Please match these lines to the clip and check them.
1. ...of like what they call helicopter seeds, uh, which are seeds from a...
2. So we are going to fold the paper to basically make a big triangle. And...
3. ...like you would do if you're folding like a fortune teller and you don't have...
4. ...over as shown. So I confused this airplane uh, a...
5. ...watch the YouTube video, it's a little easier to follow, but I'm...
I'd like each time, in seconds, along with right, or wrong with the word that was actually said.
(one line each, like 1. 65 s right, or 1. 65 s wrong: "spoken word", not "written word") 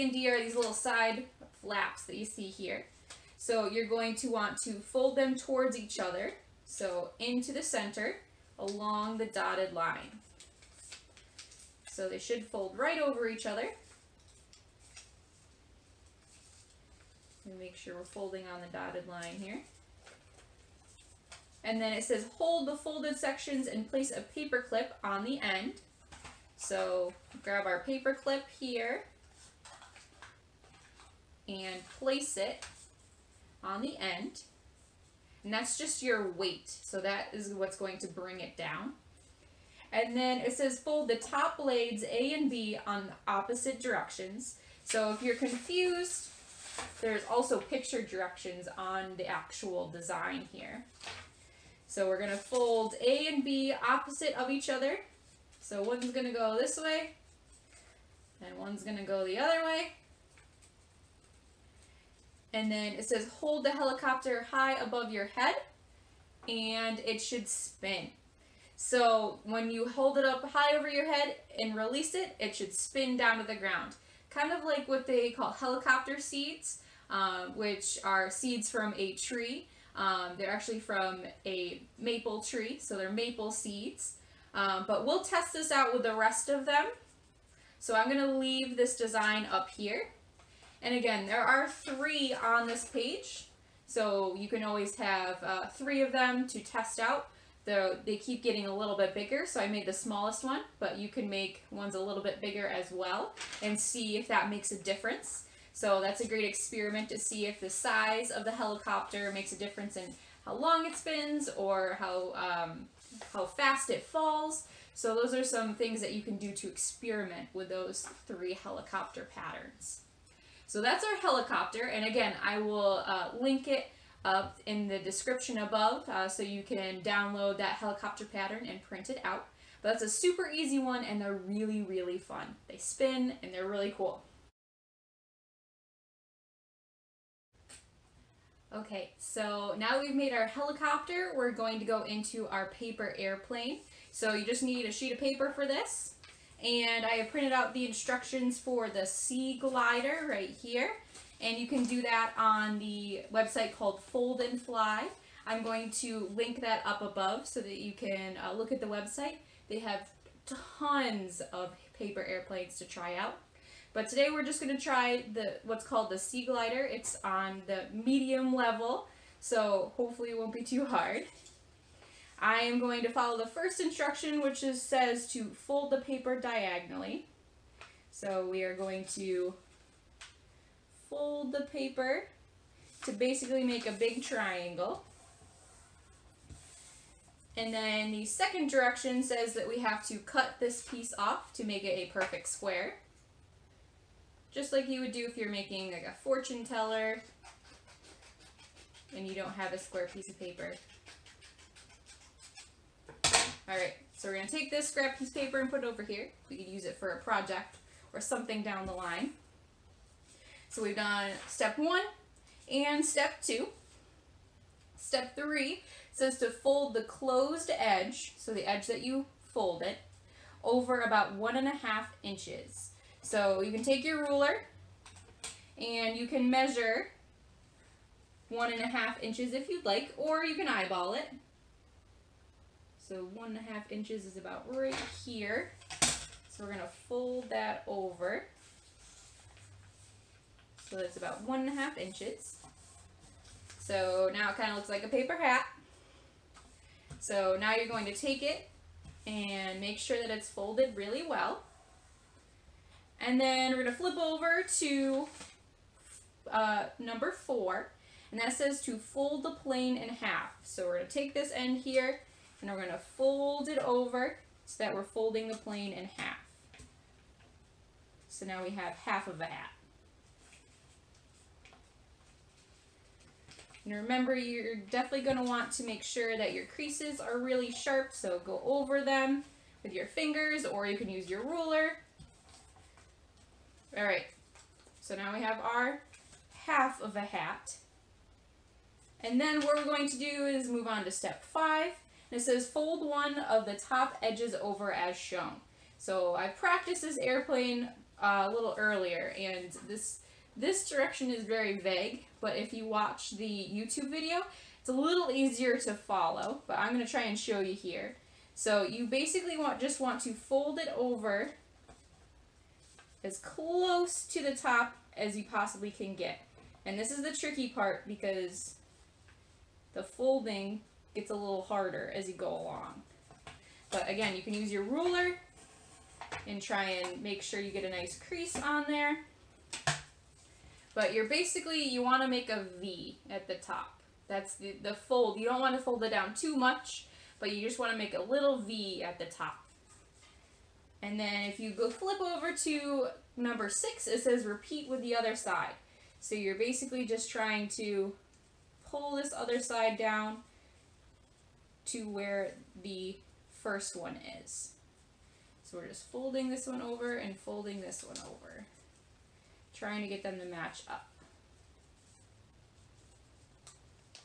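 1. 74 s right
2. 178 s right
3. 194 s wrong: "making", not "folding"
4. 294 s wrong: "practiced", not "confused"
5. 302 s right.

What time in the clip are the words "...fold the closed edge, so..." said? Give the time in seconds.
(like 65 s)
216 s.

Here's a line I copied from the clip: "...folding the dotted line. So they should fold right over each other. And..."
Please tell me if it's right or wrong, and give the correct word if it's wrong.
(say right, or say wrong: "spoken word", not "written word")
wrong: "along", not "folding".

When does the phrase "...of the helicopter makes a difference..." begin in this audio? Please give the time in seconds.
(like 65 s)
108 s.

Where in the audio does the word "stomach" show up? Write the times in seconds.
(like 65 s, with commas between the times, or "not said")
not said.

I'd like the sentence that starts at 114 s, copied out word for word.
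So those are some things that you can do to experiment with those three helicopter patterns.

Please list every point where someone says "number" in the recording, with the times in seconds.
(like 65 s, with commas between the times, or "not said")
256 s, 343 s.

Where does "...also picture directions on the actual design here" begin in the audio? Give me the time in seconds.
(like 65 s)
47 s.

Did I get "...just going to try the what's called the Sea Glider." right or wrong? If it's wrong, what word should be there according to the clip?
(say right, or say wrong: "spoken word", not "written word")
right.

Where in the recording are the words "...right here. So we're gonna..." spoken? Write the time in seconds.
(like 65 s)
234 s.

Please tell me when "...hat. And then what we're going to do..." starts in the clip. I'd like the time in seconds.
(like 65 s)
287 s.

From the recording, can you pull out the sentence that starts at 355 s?
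So we're just folding this one over and folding this one over, trying to get them to match up.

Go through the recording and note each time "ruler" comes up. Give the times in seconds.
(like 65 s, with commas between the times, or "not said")
224 s, 281 s, 324 s.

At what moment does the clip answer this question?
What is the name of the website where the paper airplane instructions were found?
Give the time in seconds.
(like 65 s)
154 s.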